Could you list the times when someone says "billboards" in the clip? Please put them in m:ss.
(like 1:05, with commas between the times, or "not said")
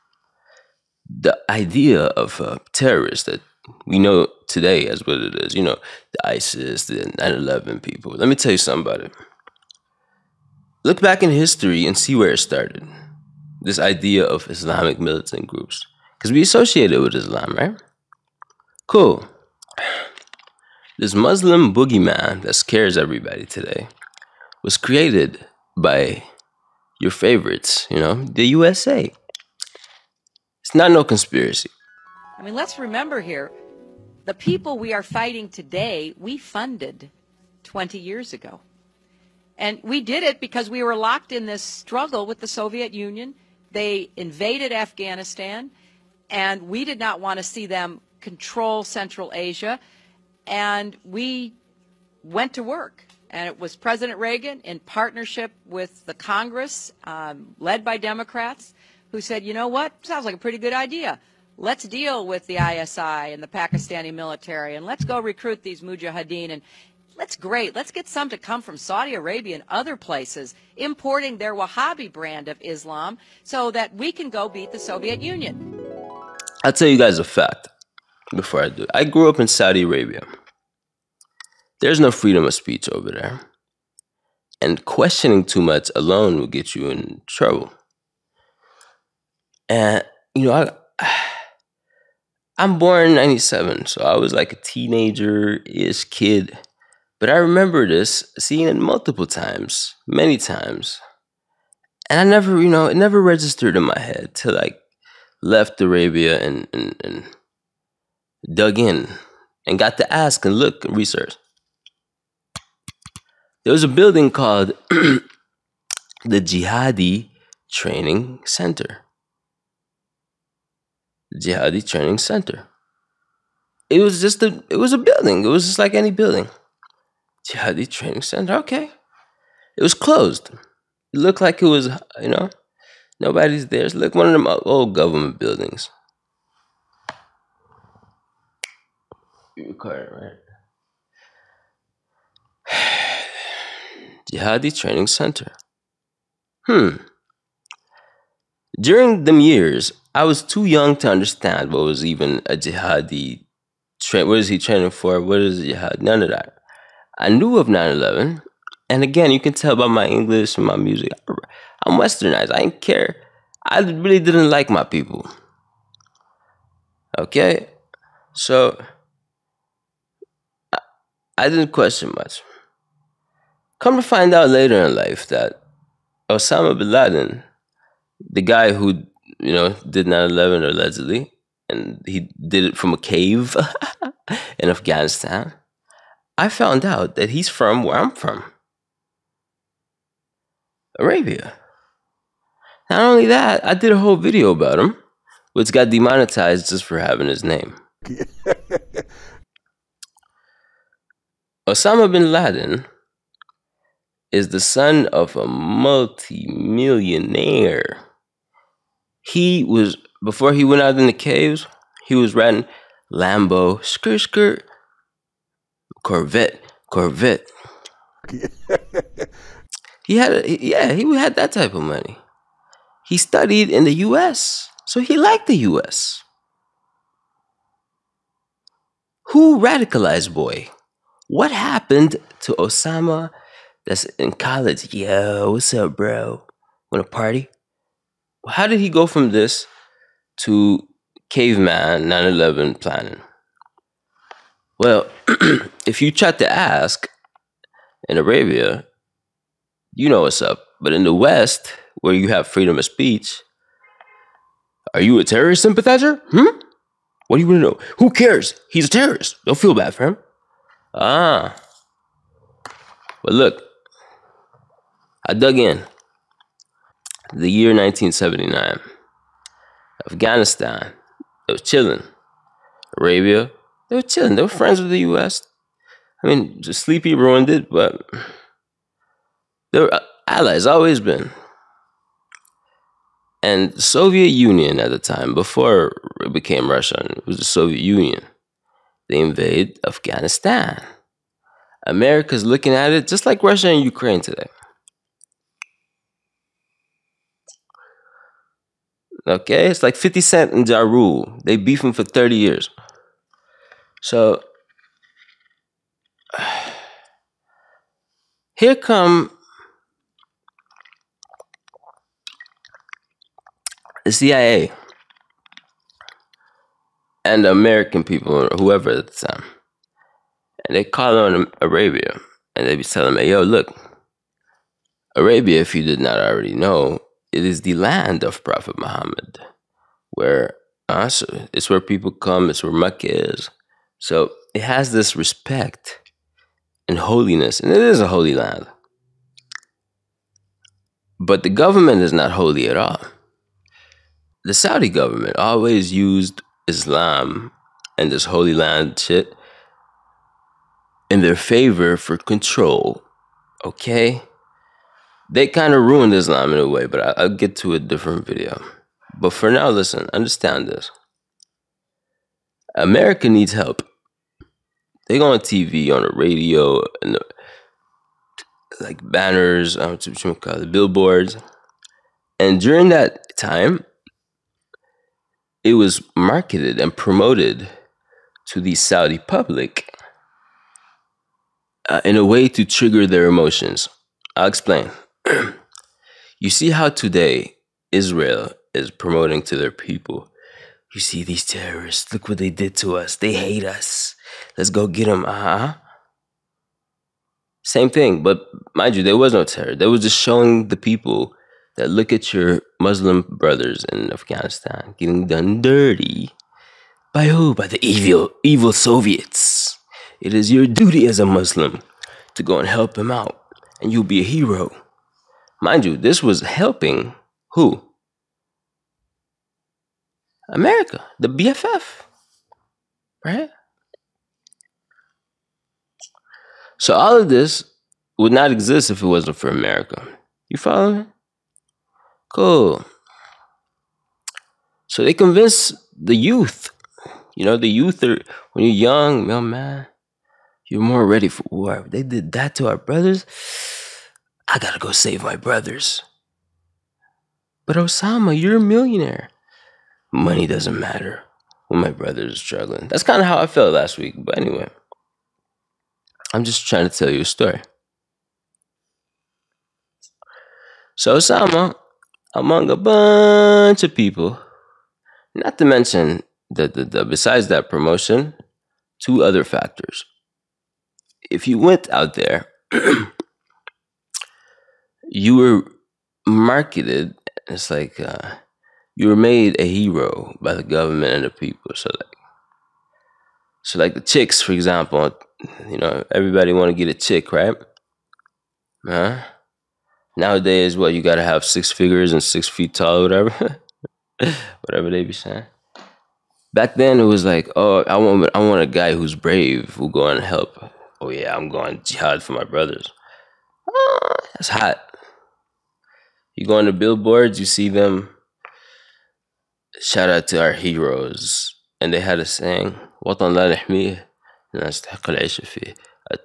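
6:10, 8:26.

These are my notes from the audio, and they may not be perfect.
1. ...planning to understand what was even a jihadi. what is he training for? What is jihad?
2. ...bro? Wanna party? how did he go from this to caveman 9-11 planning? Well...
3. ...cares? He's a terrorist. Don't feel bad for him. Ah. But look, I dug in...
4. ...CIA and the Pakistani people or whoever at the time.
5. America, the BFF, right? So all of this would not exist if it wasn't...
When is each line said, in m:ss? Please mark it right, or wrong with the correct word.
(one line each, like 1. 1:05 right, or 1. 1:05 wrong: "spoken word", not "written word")
1. 2:30 wrong: "young", not "planning"
2. 3:55 right
3. 4:18 right
4. 5:14 wrong: "American", not "Pakistani"
5. 7:00 right.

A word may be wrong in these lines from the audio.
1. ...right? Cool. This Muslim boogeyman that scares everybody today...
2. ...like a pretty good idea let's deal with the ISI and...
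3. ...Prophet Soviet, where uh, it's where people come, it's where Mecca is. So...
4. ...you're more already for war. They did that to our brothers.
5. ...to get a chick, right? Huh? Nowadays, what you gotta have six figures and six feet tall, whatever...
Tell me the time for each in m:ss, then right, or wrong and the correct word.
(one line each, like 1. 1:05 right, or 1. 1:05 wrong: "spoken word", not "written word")
1. 0:17 right
2. 1:00 right
3. 5:28 wrong: "Muhammad", not "Soviet"
4. 7:20 wrong: "ready", not "already"
5. 8:06 right.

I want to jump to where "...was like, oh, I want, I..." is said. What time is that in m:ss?
8:17.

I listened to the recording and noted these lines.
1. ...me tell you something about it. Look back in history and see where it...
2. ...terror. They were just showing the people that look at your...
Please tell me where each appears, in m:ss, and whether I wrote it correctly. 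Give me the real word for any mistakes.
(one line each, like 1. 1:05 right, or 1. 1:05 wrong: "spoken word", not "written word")
1. 0:08 right
2. 6:39 right.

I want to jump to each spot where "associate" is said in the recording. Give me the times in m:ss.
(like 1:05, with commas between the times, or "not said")
0:16.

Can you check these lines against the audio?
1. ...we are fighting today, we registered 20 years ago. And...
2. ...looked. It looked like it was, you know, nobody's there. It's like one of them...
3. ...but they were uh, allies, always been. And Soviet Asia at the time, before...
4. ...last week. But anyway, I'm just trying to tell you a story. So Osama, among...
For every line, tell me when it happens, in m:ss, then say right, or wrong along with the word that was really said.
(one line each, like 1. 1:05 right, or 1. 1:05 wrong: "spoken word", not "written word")
1. 0:34 wrong: "funded", not "registered"
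2. 2:09 wrong: "closed", not "looked"
3. 4:37 wrong: "Union", not "Asia"
4. 7:33 right.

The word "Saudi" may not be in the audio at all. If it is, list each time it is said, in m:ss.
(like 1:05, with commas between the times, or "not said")
1:08, 1:19, 5:44, 6:18.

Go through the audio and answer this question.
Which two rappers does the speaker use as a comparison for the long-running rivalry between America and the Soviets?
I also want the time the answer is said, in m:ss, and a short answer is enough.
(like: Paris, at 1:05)
50 Cent and Ja Rule, at 4:59.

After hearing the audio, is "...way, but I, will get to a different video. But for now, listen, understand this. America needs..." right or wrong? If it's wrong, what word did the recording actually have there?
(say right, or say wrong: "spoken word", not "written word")
right.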